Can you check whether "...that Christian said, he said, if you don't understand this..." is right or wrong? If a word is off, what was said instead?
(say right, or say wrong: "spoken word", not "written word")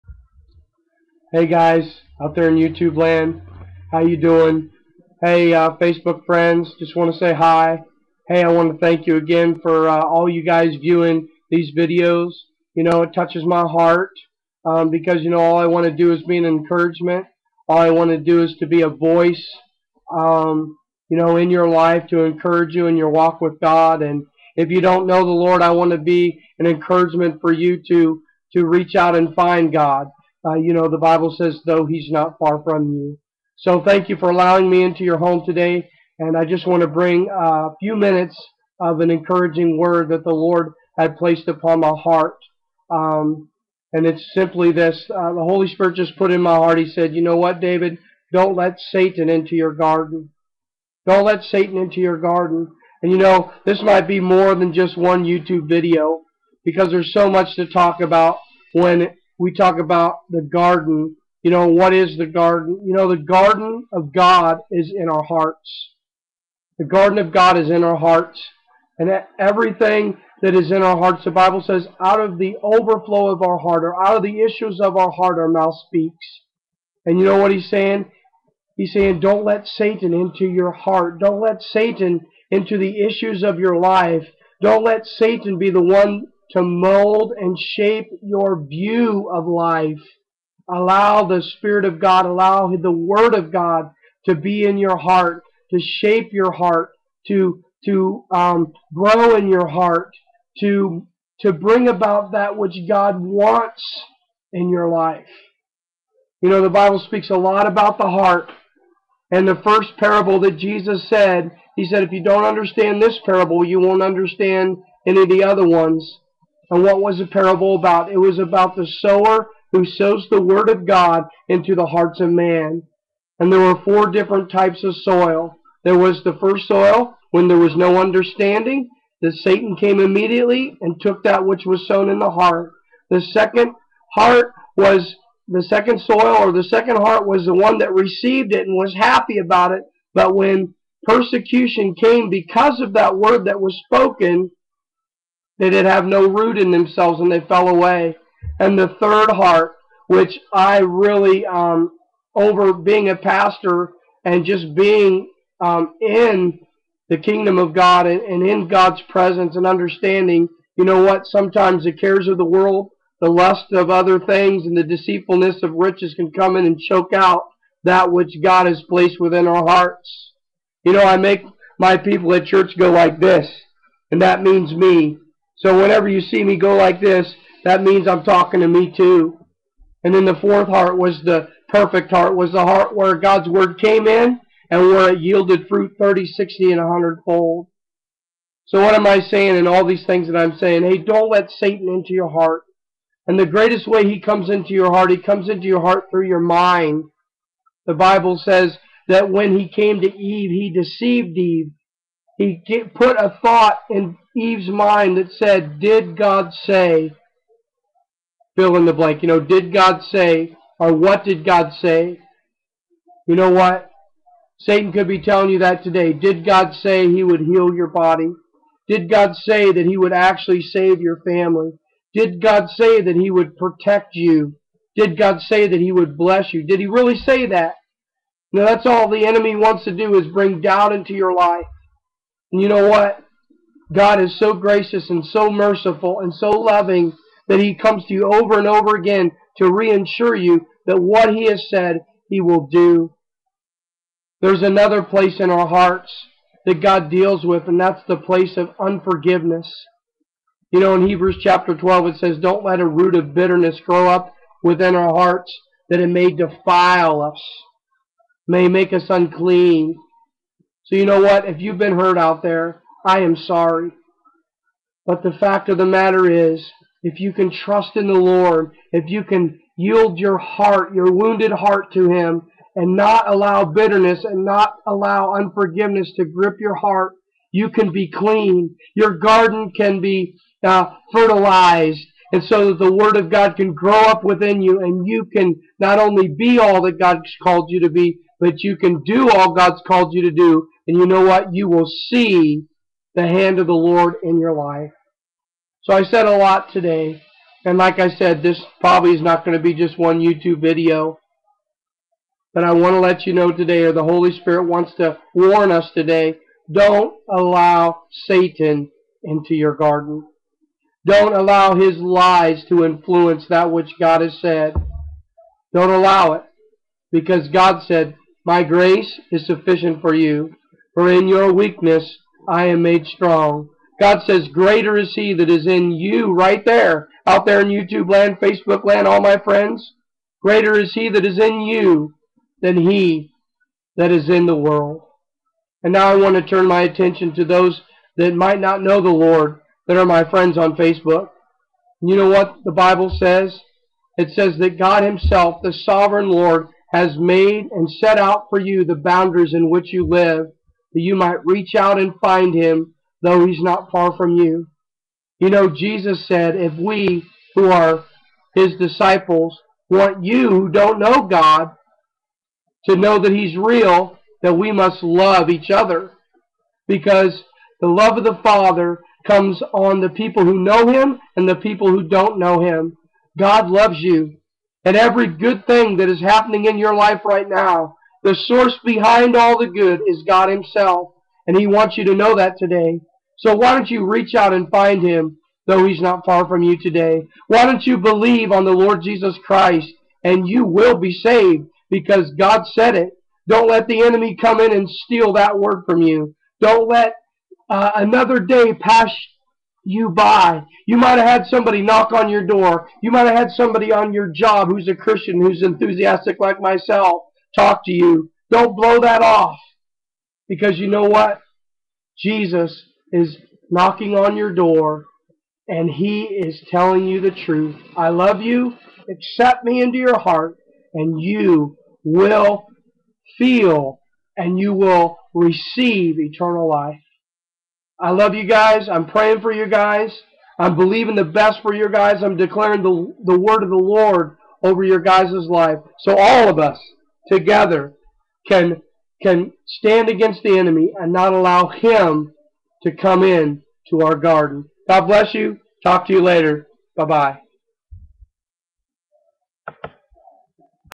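wrong: "Jesus", not "Christian".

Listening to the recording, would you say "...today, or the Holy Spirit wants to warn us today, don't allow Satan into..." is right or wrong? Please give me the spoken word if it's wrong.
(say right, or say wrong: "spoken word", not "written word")
right.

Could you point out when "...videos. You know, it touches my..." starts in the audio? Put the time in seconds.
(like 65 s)
11 s.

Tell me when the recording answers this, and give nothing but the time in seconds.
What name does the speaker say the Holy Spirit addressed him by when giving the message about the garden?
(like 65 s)
47 s.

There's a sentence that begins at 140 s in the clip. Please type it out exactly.
But when persecution came because of that word that was spoken, they did have no root in themselves and they fell away.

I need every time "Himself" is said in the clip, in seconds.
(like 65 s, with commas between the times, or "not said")
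345 s, 380 s.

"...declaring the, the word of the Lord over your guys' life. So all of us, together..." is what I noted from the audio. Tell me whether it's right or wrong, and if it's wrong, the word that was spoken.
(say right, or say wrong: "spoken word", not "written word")
right.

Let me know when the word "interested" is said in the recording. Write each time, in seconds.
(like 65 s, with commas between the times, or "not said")
not said.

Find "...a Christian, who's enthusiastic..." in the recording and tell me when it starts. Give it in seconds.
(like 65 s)
404 s.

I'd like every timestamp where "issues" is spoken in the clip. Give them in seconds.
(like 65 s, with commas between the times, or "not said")
74 s, 83 s.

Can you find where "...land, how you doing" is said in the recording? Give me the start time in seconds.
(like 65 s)
2 s.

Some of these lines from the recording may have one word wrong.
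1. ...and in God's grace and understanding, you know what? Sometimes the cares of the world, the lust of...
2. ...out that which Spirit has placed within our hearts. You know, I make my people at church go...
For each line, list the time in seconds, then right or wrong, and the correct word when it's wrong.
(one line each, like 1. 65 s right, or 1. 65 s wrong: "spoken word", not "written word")
1. 158 s wrong: "presence", not "grace"
2. 167 s wrong: "God", not "Spirit".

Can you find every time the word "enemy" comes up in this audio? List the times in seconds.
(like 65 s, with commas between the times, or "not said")
229 s, 394 s, 440 s.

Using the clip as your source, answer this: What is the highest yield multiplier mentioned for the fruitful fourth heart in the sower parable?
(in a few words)
100 fold.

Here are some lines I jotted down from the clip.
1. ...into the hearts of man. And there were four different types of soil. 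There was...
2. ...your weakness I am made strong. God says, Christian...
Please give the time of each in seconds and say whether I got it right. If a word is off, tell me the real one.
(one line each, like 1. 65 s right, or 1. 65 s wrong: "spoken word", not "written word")
1. 121 s right
2. 321 s wrong: "Greater", not "Christian".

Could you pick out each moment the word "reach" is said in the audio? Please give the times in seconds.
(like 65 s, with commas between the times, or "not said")
28 s, 351 s, 384 s.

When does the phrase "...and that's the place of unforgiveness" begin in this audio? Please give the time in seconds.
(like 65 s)
247 s.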